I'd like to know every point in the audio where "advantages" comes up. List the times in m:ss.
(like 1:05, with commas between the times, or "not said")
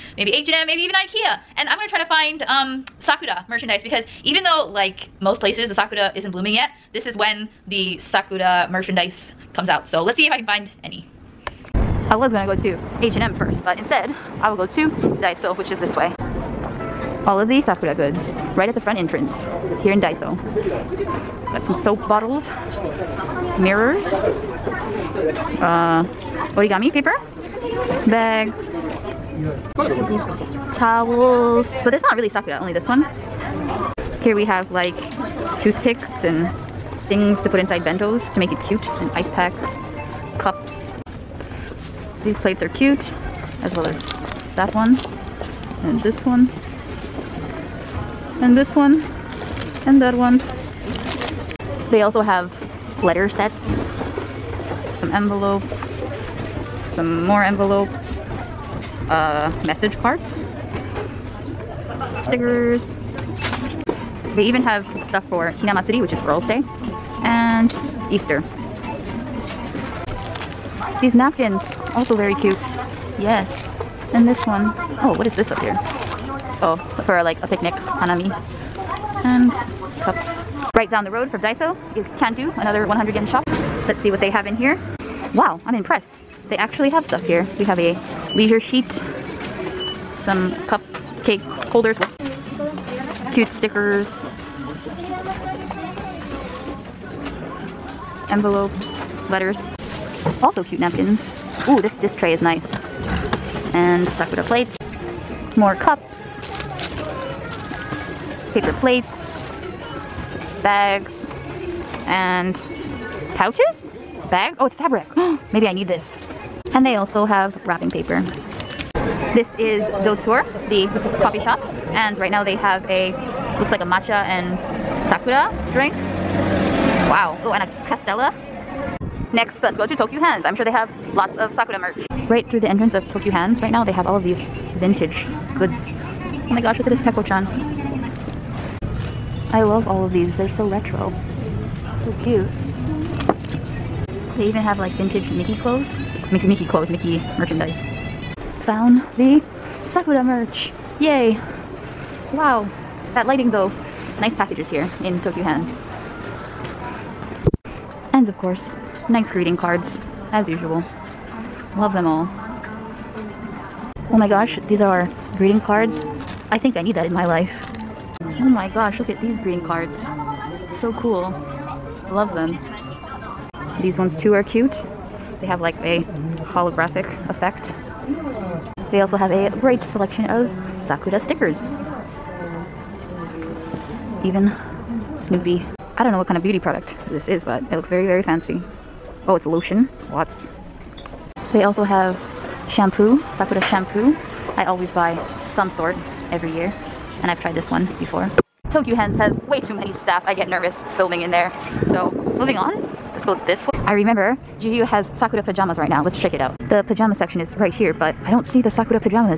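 not said.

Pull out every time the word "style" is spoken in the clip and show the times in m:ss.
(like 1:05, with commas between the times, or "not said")
not said.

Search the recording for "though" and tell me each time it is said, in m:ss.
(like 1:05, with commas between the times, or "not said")
0:04, 2:33.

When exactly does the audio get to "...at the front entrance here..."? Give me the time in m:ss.
0:18.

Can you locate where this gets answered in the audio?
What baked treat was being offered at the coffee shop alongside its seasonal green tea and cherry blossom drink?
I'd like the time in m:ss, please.
2:07.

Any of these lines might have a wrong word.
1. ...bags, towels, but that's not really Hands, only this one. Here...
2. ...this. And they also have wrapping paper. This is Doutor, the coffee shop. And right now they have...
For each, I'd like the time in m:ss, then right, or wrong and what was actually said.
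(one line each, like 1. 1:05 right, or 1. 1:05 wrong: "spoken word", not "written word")
1. 0:28 wrong: "Sakura", not "Hands"
2. 1:55 right.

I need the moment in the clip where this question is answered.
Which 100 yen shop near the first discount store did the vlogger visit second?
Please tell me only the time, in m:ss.
1:22.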